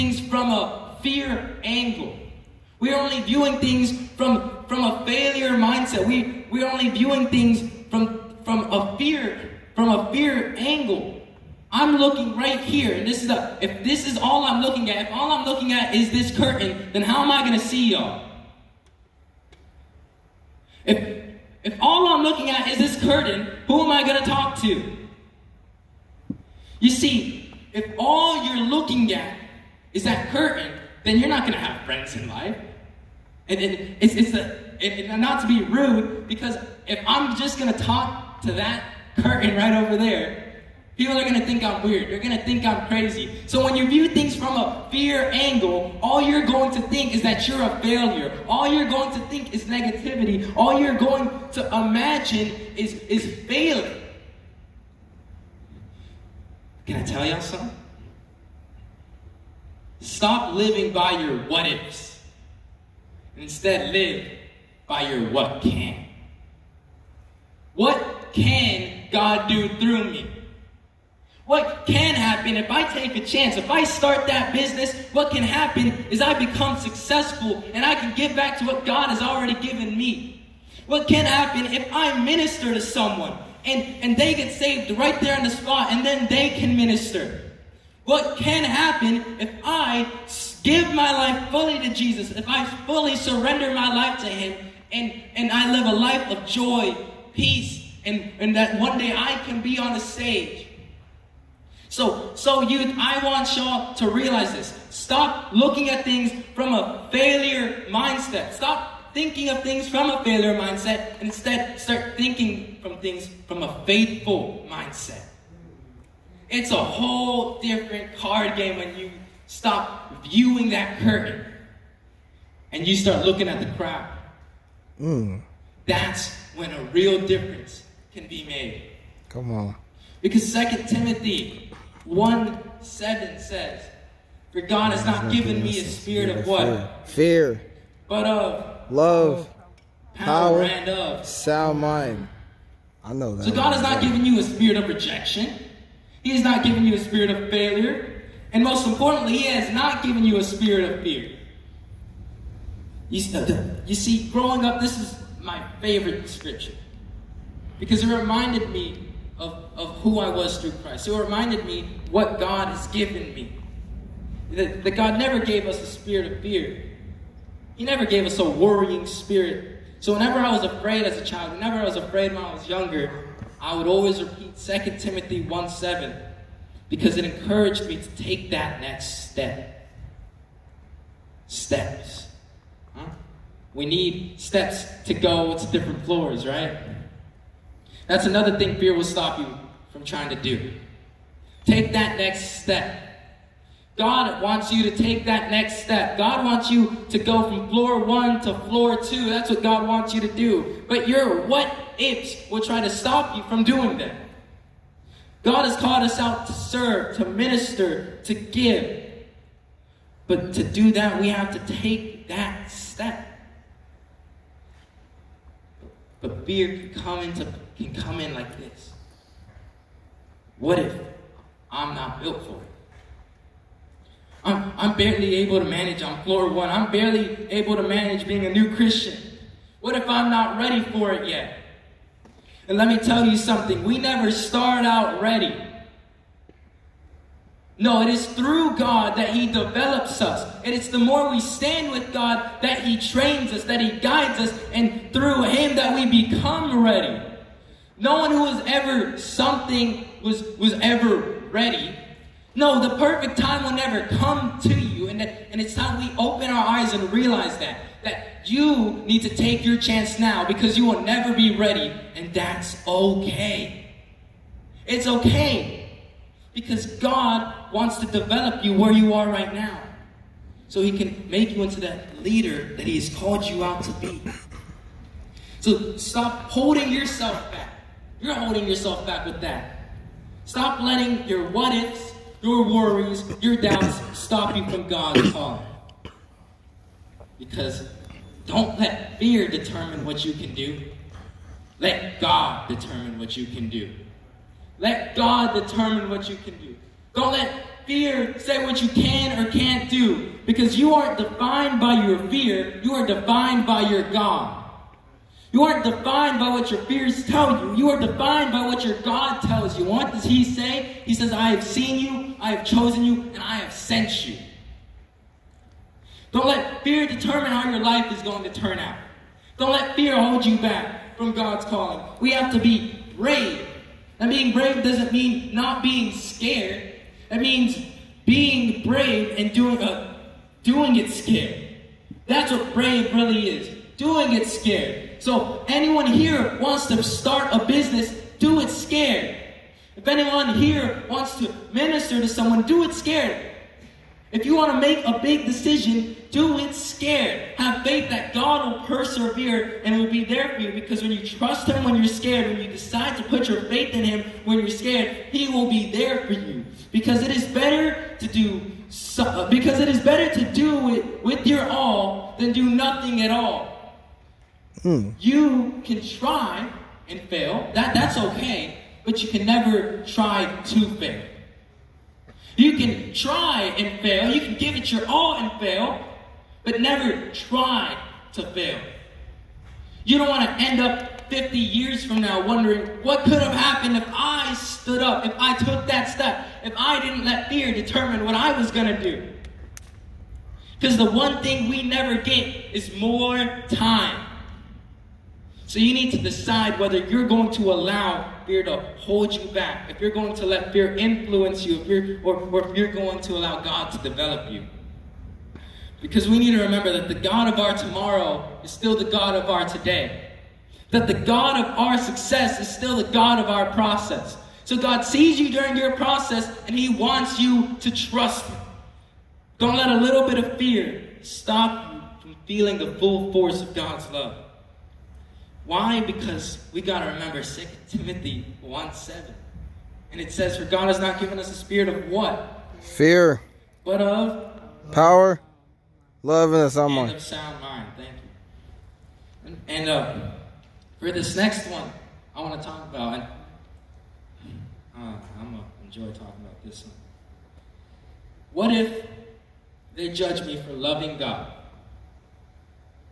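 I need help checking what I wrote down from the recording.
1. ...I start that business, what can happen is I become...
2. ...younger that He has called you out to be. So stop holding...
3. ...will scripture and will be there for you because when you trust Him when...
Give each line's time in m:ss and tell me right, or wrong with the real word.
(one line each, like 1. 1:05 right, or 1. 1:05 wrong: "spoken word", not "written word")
1. 1:13 right
2. 4:32 wrong: "leader", not "younger"
3. 5:48 wrong: "persevere", not "scripture".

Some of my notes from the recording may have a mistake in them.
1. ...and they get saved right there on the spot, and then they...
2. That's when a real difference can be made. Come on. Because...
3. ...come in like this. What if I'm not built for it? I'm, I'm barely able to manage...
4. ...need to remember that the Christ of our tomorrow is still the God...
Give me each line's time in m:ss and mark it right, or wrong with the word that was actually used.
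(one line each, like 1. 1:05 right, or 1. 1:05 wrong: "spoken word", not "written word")
1. 1:24 right
2. 2:05 right
3. 3:37 right
4. 6:46 wrong: "God", not "Christ".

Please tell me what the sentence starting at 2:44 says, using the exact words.
That, that God never gave us a spirit of fear, he never gave us a worrying spirit.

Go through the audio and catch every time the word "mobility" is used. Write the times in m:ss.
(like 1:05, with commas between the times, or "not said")
not said.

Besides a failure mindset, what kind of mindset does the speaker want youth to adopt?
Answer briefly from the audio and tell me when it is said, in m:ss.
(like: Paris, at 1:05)
faithful mindset, at 1:53.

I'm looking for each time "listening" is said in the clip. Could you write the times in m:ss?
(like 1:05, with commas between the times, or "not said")
not said.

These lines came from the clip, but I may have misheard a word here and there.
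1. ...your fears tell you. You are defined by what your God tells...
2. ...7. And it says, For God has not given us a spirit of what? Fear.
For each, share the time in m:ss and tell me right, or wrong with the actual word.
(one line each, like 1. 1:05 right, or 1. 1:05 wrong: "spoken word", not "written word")
1. 5:06 right
2. 7:08 right.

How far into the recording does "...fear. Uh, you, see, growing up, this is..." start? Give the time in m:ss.
2:31.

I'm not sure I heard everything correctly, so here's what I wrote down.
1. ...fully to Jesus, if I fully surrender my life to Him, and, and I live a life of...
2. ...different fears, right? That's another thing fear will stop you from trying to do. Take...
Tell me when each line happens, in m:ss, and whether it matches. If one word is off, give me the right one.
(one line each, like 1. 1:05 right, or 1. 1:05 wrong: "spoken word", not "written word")
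1. 1:31 right
2. 3:05 wrong: "floors", not "fears".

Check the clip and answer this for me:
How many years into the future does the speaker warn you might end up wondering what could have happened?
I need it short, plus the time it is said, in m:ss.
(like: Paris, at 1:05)
50, at 6:21.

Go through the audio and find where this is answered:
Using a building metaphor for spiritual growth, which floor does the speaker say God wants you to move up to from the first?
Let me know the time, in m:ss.
3:18.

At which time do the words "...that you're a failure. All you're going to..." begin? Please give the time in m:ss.
0:47.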